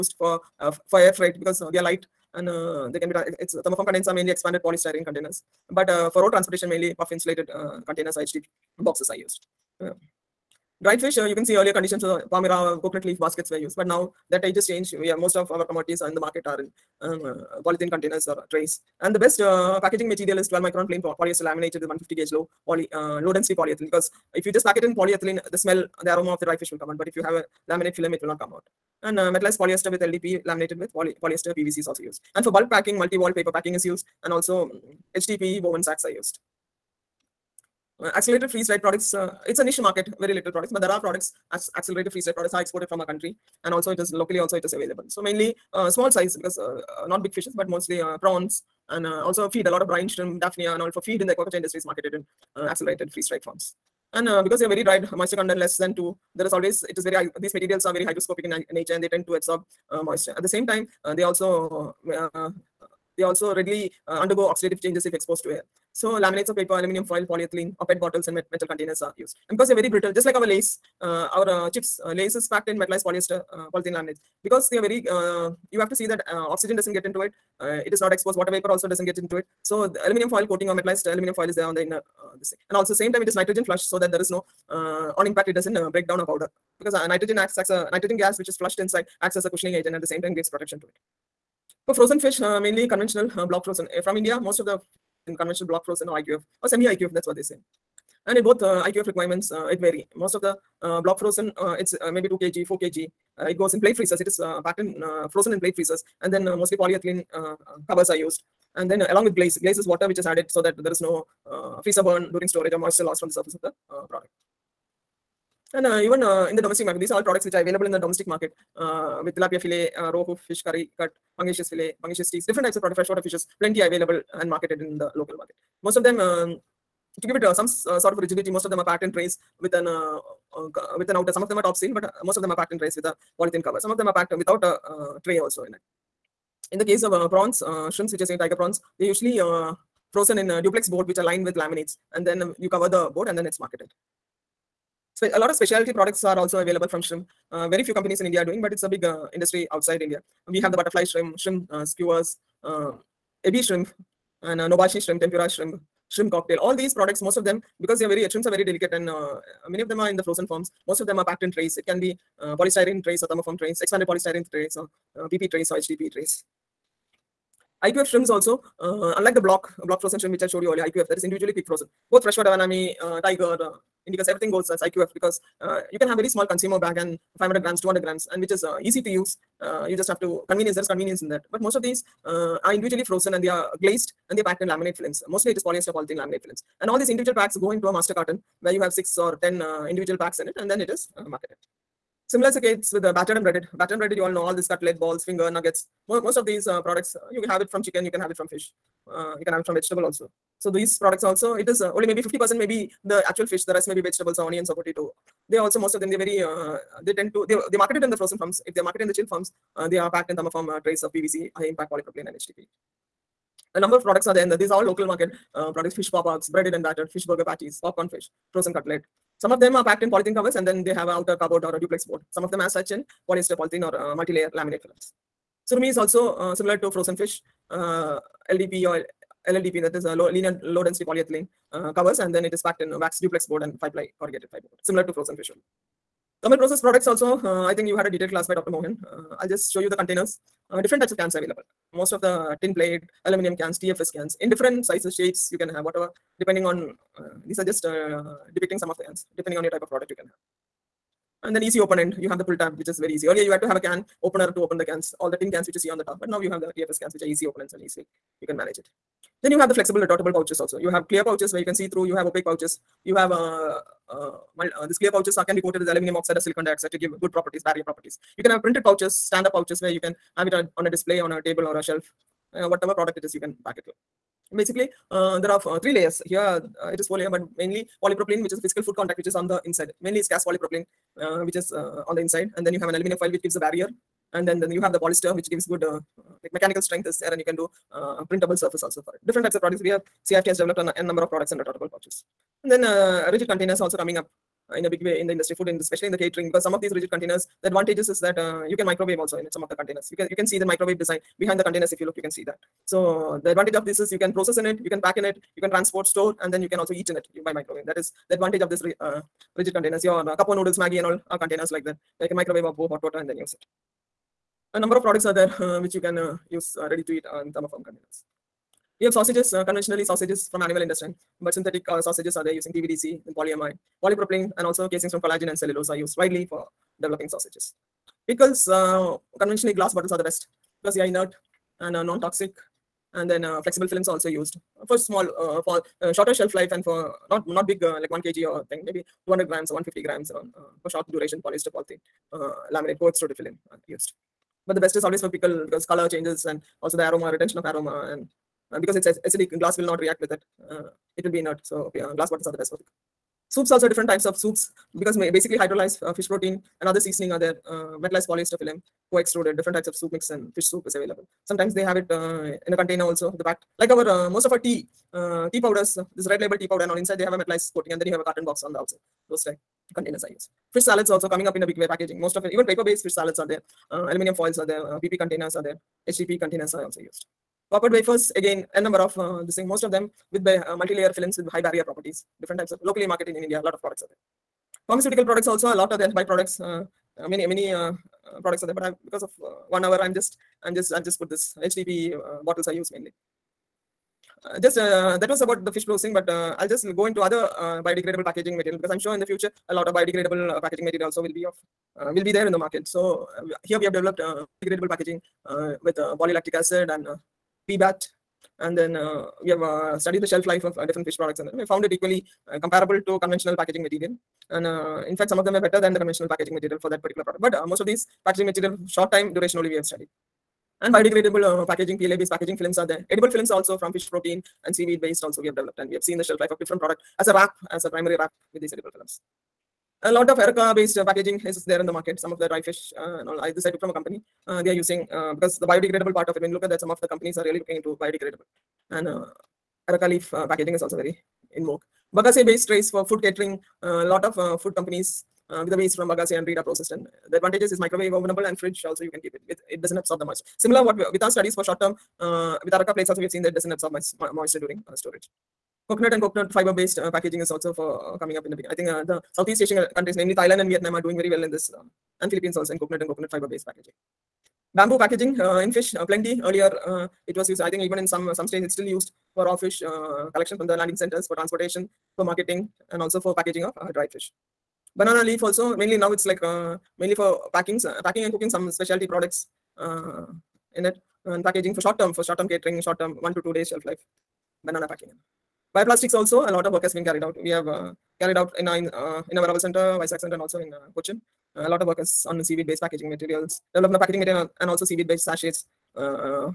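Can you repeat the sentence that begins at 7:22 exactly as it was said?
Bagasse based trays for food catering.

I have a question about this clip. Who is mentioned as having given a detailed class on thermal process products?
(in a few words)
Dr. Mohan.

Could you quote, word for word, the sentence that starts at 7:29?
It, it doesn't absorb the moisture.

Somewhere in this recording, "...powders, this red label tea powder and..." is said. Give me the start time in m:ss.
6:05.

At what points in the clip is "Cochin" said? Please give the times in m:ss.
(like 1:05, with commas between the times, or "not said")
8:10.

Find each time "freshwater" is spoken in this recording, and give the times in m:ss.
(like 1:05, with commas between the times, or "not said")
2:02, 2:52.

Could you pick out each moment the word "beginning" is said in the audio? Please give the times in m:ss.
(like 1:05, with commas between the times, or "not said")
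7:38.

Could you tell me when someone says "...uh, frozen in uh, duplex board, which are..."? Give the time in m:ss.
2:19.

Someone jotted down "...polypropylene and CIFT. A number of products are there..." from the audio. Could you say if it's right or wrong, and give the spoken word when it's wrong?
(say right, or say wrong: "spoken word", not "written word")
wrong: "HDP", not "CIFT".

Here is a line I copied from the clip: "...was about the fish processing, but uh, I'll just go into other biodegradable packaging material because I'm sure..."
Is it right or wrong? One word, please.
right.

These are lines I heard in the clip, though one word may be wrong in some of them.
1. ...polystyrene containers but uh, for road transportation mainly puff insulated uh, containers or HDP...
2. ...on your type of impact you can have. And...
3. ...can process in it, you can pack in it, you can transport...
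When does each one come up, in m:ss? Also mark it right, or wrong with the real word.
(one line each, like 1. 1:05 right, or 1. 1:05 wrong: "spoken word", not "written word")
1. 0:04 right
2. 4:09 wrong: "product", not "impact"
3. 5:04 right.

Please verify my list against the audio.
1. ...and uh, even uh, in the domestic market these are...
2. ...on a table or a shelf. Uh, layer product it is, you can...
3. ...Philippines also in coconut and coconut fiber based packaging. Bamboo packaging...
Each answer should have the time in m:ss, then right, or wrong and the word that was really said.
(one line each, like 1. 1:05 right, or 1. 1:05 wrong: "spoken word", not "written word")
1. 1:55 right
2. 4:31 wrong: "whatever", not "layer"
3. 7:42 right.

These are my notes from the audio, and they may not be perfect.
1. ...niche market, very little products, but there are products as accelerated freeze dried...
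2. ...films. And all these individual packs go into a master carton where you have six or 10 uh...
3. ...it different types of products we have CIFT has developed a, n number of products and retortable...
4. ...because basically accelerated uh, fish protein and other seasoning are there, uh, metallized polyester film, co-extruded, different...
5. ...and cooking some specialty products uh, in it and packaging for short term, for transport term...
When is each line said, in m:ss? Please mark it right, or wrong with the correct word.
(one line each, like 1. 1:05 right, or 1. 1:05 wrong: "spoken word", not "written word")
1. 0:39 right
2. 3:06 right
3. 4:49 right
4. 5:54 wrong: "hydrolyzed", not "accelerated"
5. 7:58 wrong: "short", not "transport".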